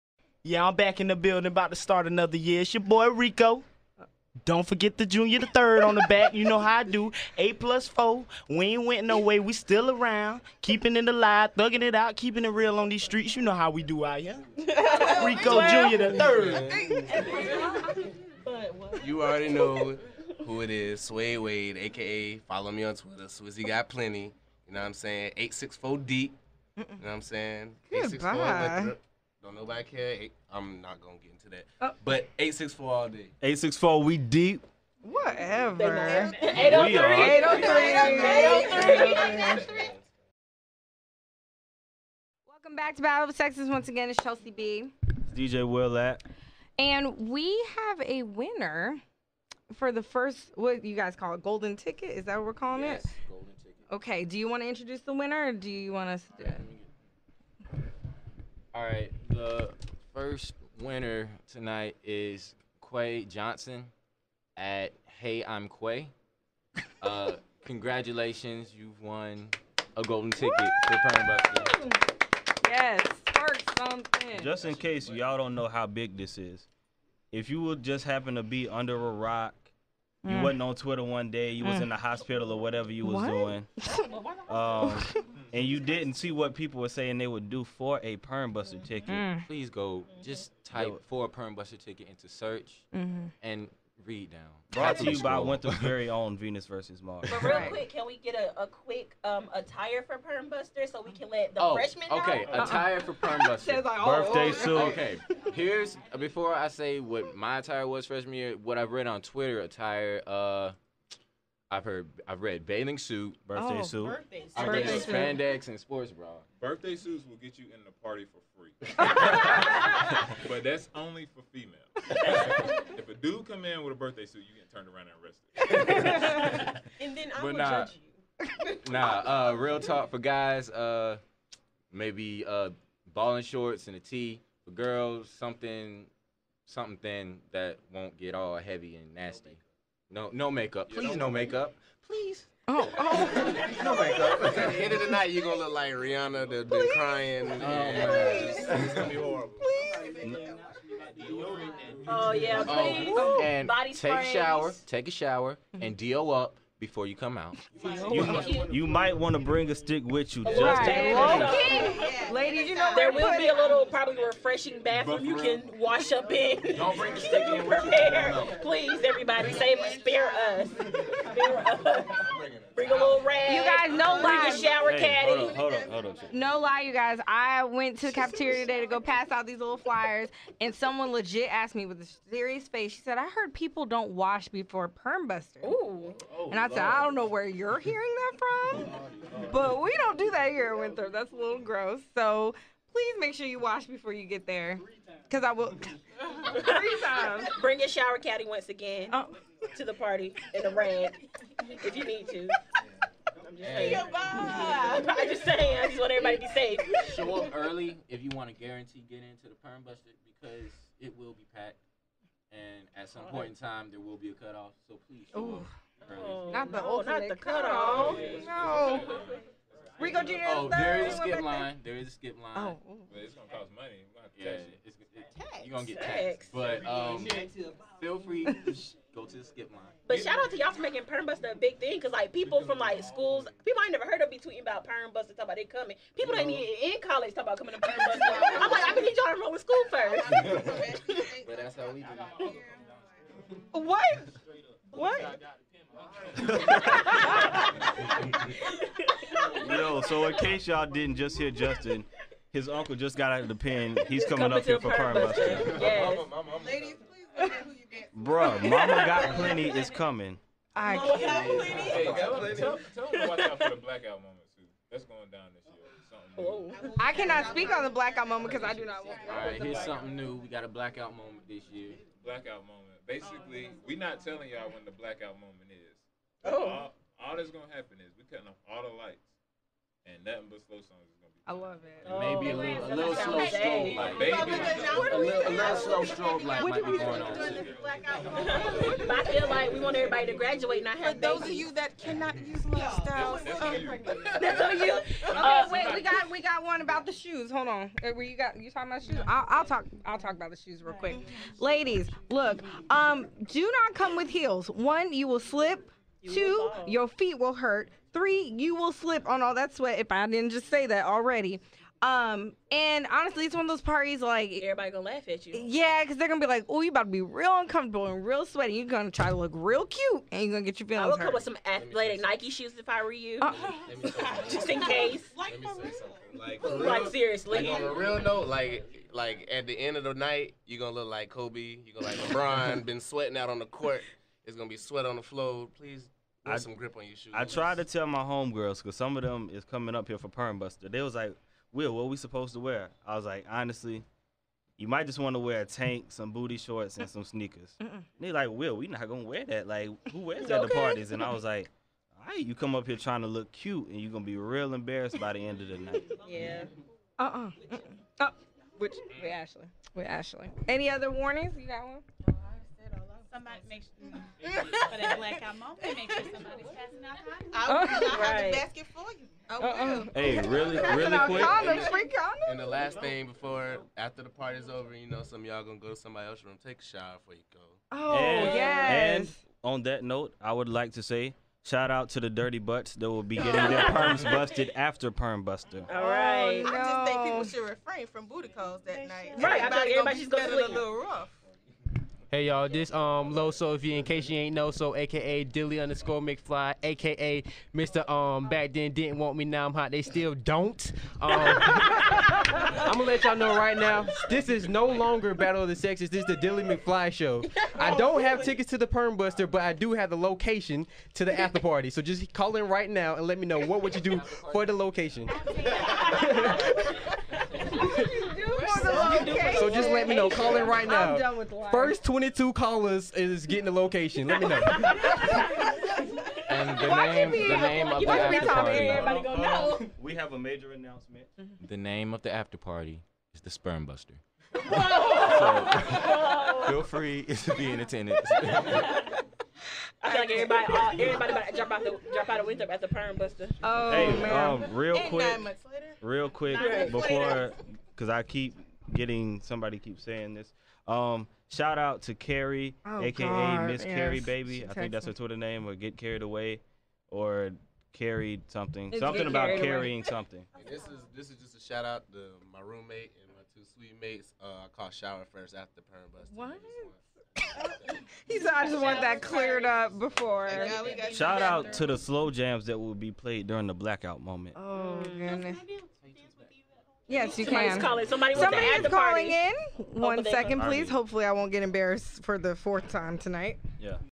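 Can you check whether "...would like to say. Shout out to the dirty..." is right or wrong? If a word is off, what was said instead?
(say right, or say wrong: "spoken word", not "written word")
right.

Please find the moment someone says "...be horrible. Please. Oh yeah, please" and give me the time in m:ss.
2:29.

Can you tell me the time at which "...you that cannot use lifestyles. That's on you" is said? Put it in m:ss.
4:51.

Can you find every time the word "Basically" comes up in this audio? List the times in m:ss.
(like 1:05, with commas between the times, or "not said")
4:33.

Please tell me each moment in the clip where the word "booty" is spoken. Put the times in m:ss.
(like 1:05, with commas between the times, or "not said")
5:46, 6:28.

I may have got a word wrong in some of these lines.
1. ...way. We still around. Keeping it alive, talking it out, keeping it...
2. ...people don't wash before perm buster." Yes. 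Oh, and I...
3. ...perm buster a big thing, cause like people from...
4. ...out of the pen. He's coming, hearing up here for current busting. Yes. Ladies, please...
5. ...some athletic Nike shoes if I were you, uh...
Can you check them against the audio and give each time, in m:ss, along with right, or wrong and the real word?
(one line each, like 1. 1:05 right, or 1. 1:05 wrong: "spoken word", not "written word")
1. 0:09 wrong: "thugging", not "talking"
2. 3:03 wrong: "Ooh", not "Yes"
3. 3:51 right
4. 4:13 wrong: "coming", not "hearing"
5. 5:21 right.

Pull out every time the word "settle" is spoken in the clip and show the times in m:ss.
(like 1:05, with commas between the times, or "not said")
not said.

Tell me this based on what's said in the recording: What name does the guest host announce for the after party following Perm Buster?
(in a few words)
Sperm Buster.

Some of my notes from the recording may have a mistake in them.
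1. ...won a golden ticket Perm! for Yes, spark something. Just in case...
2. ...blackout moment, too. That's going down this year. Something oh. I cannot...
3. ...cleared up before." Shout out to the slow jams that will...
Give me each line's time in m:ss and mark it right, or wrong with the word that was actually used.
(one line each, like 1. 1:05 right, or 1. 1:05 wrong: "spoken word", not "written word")
1. 1:09 wrong: "Woo", not "Perm"
2. 4:23 right
3. 7:49 right.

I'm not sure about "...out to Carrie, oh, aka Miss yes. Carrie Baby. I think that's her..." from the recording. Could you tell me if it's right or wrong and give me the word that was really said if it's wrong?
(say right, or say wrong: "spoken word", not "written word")
right.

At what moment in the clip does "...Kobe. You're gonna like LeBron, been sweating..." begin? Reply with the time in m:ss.
5:31.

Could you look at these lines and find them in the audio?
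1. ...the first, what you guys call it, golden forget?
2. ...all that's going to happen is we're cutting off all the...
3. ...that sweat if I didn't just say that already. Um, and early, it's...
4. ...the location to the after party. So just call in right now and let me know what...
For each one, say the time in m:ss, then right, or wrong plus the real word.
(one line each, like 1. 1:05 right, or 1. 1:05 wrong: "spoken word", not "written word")
1. 0:49 wrong: "ticket", not "forget"
2. 4:37 right
3. 5:09 wrong: "honestly", not "early"
4. 6:50 right.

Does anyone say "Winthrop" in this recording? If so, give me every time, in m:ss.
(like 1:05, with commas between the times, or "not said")
1:35, 3:10.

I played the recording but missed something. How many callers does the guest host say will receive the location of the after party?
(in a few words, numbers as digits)
22.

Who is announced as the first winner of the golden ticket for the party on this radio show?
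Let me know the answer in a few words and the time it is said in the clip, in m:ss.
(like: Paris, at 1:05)
Quay Johnson, at 1:02.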